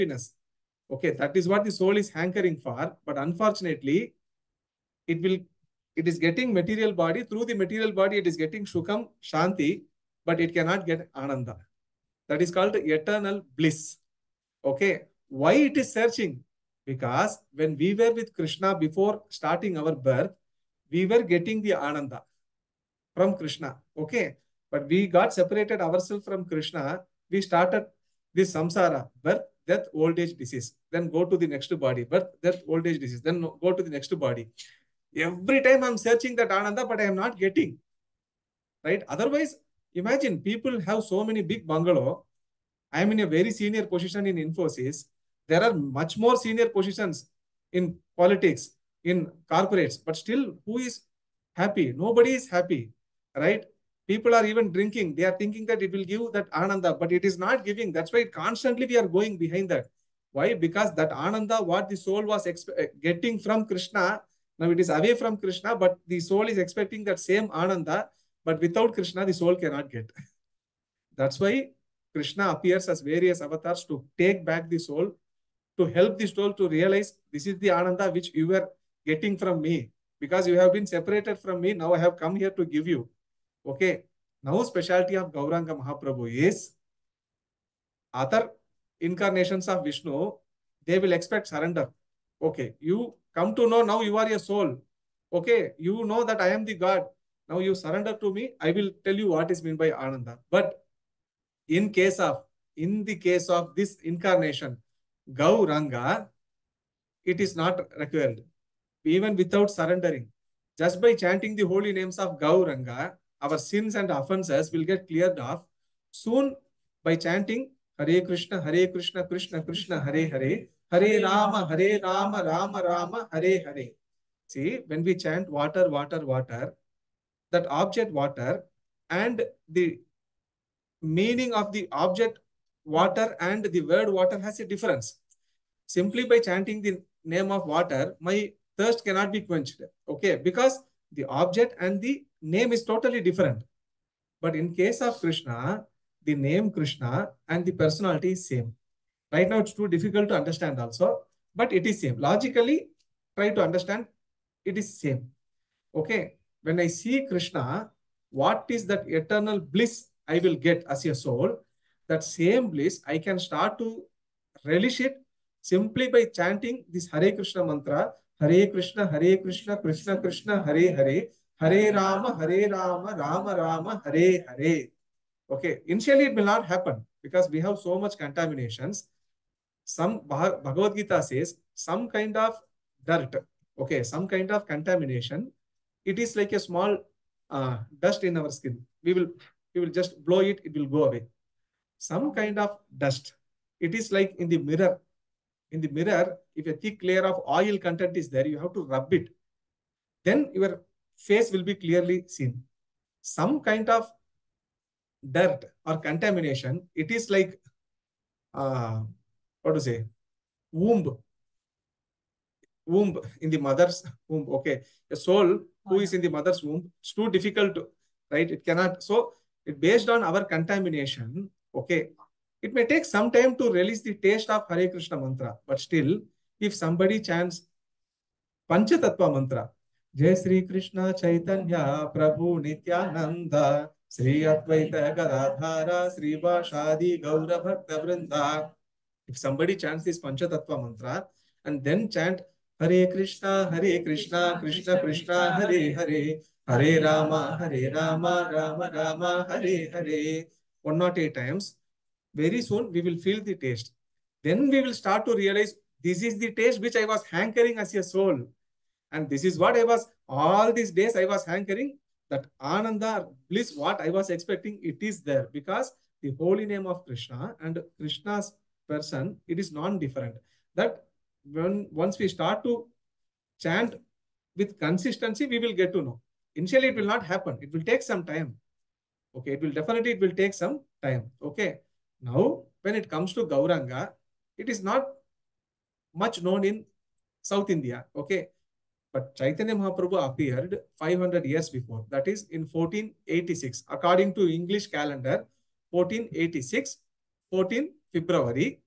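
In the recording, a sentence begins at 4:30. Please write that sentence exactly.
That when once we start to chant with consistency, we will get to know.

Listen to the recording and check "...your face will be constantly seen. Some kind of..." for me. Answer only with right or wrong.
wrong.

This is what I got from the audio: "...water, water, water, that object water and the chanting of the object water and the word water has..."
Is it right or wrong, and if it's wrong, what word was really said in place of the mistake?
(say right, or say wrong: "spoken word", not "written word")
wrong: "meaning", not "chanting".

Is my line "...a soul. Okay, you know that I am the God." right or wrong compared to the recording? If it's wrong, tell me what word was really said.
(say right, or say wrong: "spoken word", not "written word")
right.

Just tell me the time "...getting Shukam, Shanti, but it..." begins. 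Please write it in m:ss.
0:08.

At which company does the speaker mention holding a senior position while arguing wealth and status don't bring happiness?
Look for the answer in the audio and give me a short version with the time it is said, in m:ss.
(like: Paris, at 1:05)
Infosys, at 0:44.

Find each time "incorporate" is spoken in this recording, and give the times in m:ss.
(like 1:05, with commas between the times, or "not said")
not said.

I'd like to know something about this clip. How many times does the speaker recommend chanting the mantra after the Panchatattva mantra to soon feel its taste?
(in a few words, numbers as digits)
108.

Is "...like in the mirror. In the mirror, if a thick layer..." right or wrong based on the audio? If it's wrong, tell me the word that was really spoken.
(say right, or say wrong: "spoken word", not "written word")
right.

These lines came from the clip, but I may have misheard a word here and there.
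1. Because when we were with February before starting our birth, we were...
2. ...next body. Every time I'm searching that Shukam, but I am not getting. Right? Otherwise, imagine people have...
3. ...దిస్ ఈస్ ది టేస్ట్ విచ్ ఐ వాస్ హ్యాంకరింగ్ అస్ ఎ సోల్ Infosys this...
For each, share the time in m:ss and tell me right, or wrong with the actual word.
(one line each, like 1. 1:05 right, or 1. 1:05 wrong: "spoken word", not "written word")
1. 0:16 wrong: "Krishna", not "February"
2. 0:33 wrong: "Ananda", not "Shukam"
3. 4:16 wrong: "And", not "Infosys".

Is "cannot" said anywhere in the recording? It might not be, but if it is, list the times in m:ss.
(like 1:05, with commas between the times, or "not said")
0:10, 1:09, 2:19, 3:38.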